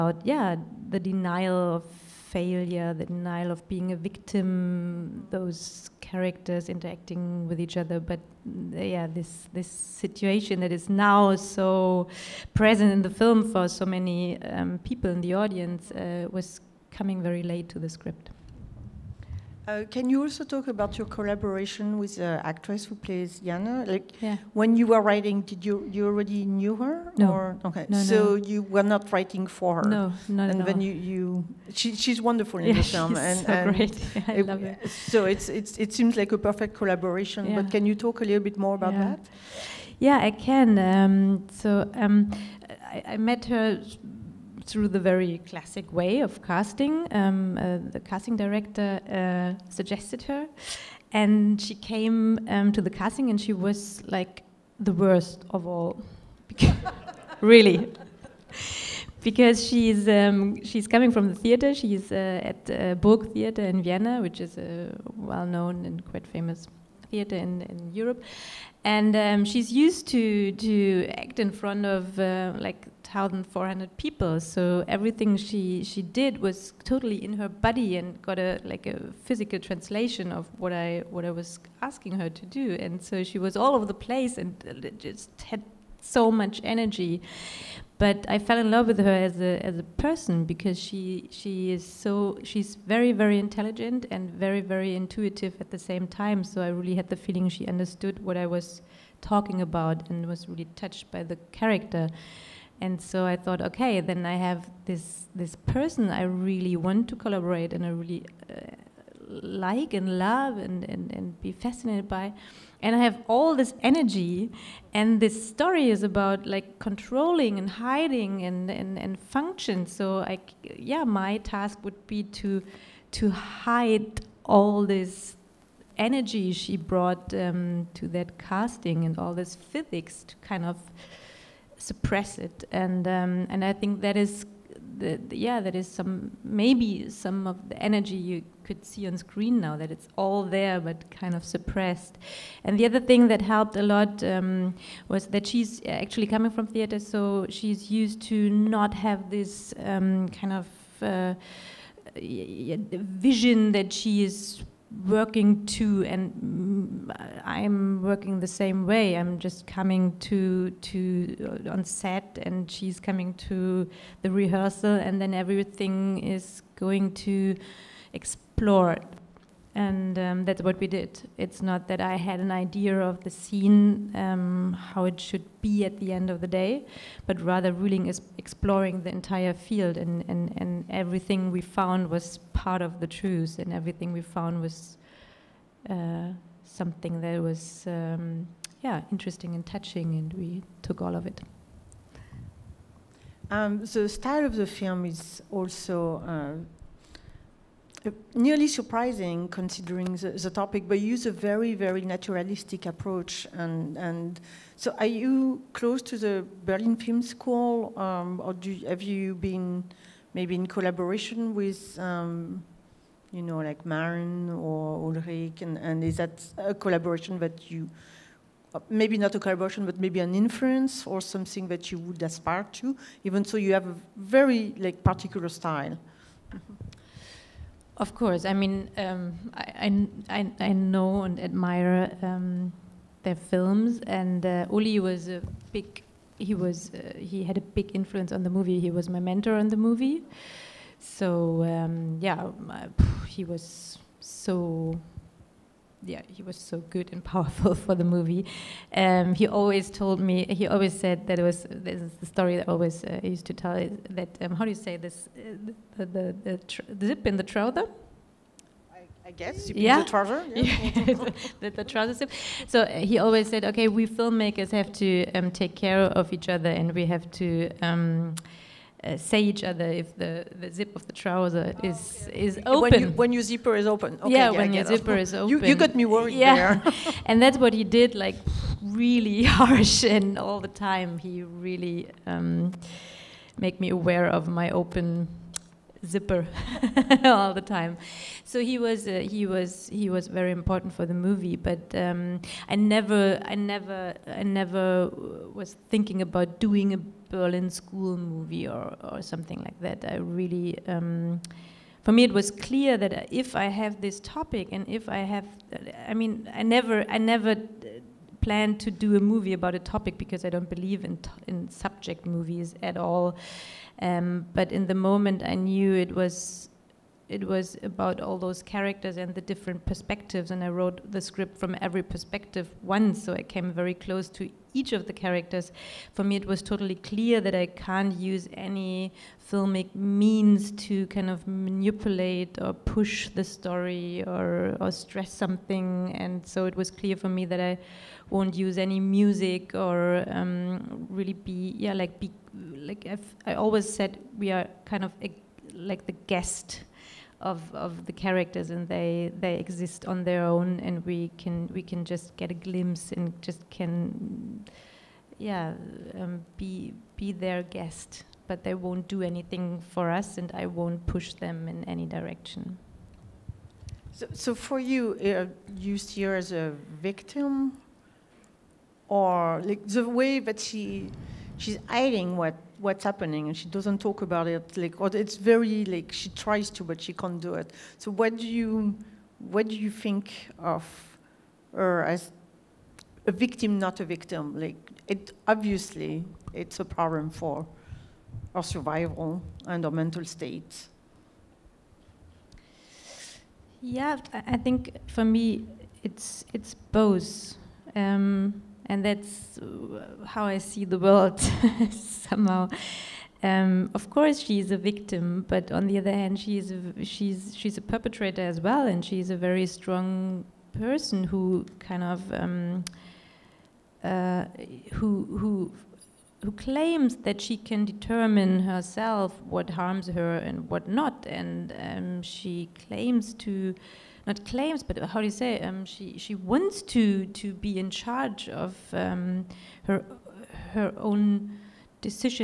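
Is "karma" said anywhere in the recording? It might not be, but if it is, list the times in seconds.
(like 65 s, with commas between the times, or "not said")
not said.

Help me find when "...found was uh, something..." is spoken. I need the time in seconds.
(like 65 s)
184 s.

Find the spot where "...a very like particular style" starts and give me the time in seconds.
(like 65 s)
223 s.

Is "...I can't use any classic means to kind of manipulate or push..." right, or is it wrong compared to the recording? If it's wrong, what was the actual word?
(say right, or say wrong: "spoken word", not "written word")
wrong: "filmic", not "classic".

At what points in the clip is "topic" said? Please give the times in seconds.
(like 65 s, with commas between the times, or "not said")
200 s, 304 s, 309 s.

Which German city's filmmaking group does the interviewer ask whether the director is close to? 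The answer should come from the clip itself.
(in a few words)
Berlin Film School.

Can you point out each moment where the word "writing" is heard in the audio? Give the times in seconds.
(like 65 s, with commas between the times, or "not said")
25 s, 29 s.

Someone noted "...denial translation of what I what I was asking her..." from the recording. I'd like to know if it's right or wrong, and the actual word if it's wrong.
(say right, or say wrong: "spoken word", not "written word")
wrong: "physical", not "denial".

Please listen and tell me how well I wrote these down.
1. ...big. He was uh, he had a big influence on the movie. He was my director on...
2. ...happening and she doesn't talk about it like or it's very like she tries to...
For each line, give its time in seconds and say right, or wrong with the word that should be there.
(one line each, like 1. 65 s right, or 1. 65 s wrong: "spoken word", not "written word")
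1. 235 s wrong: "mentor", not "director"
2. 373 s right.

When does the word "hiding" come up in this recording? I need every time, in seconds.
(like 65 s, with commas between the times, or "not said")
117 s, 371 s.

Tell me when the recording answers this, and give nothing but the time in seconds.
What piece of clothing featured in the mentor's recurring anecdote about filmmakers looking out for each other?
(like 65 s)
261 s.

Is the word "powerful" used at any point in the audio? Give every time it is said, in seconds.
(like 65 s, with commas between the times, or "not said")
247 s.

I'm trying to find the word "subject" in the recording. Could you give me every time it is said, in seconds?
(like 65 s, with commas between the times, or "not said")
311 s.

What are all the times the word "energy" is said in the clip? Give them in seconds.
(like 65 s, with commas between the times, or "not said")
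86 s, 113 s, 125 s, 137 s.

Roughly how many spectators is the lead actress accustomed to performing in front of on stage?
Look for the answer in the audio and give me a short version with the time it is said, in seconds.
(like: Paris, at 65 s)
1,400, at 73 s.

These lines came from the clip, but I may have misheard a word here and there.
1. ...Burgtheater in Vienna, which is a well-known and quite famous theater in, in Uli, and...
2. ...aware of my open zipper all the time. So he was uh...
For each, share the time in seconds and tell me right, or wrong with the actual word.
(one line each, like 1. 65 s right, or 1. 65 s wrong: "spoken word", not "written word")
1. 62 s wrong: "Europe", not "Uli"
2. 283 s right.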